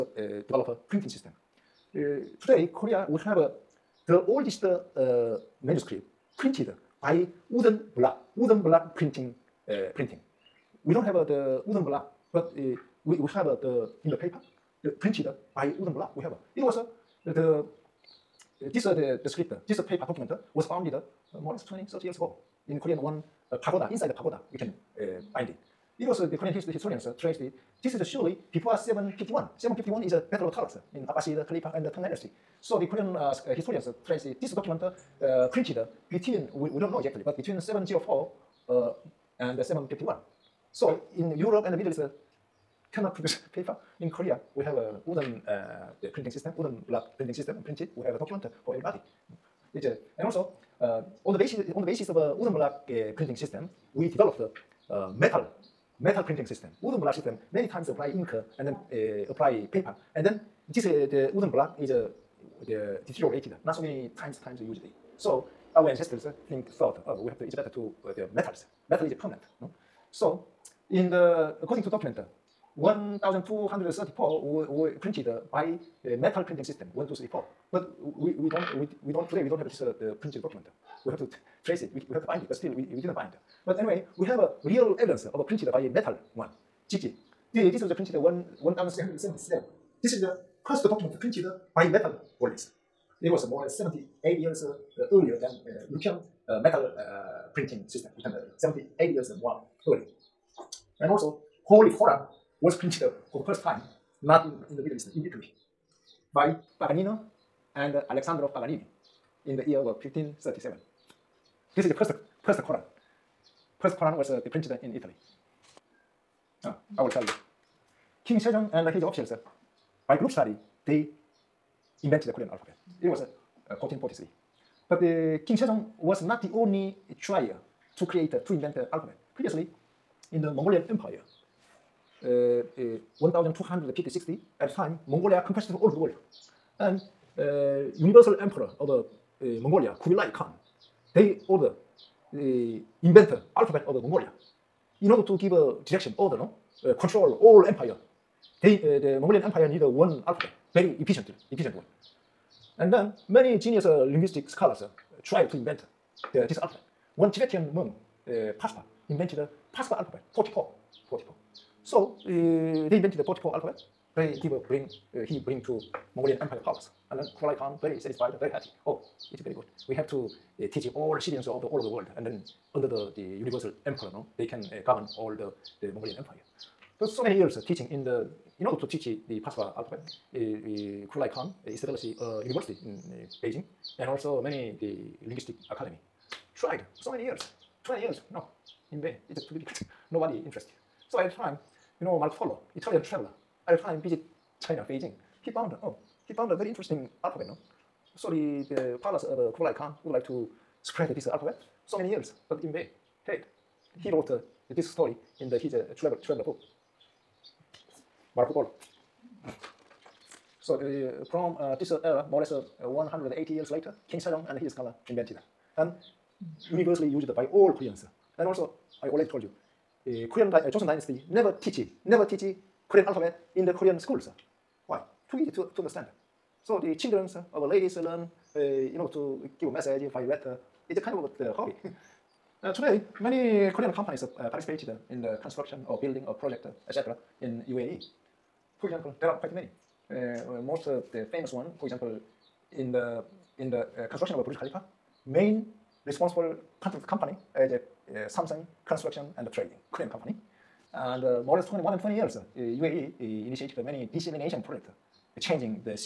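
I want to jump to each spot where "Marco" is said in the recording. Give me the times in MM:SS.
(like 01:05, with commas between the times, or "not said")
03:12, 03:28.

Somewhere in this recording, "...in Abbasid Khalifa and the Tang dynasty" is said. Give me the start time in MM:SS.
00:30.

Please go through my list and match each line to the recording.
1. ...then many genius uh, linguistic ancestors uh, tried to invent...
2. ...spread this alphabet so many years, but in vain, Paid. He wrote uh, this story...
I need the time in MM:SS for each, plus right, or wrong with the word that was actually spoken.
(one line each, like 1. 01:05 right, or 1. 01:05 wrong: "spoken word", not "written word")
1. 02:32 wrong: "scholars", not "ancestors"
2. 03:20 right.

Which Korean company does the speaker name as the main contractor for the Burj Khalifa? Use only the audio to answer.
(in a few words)
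Samsung construction and trading.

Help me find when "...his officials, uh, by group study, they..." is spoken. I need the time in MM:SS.
01:58.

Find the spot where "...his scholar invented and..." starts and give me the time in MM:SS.
03:34.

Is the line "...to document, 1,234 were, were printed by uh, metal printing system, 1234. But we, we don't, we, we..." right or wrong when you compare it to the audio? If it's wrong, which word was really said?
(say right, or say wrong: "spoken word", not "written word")
right.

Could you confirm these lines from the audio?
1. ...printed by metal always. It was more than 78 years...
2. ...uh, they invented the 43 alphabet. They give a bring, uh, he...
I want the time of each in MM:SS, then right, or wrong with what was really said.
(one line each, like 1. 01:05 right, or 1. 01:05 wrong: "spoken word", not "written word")
1. 01:31 right
2. 02:42 wrong: "44", not "43".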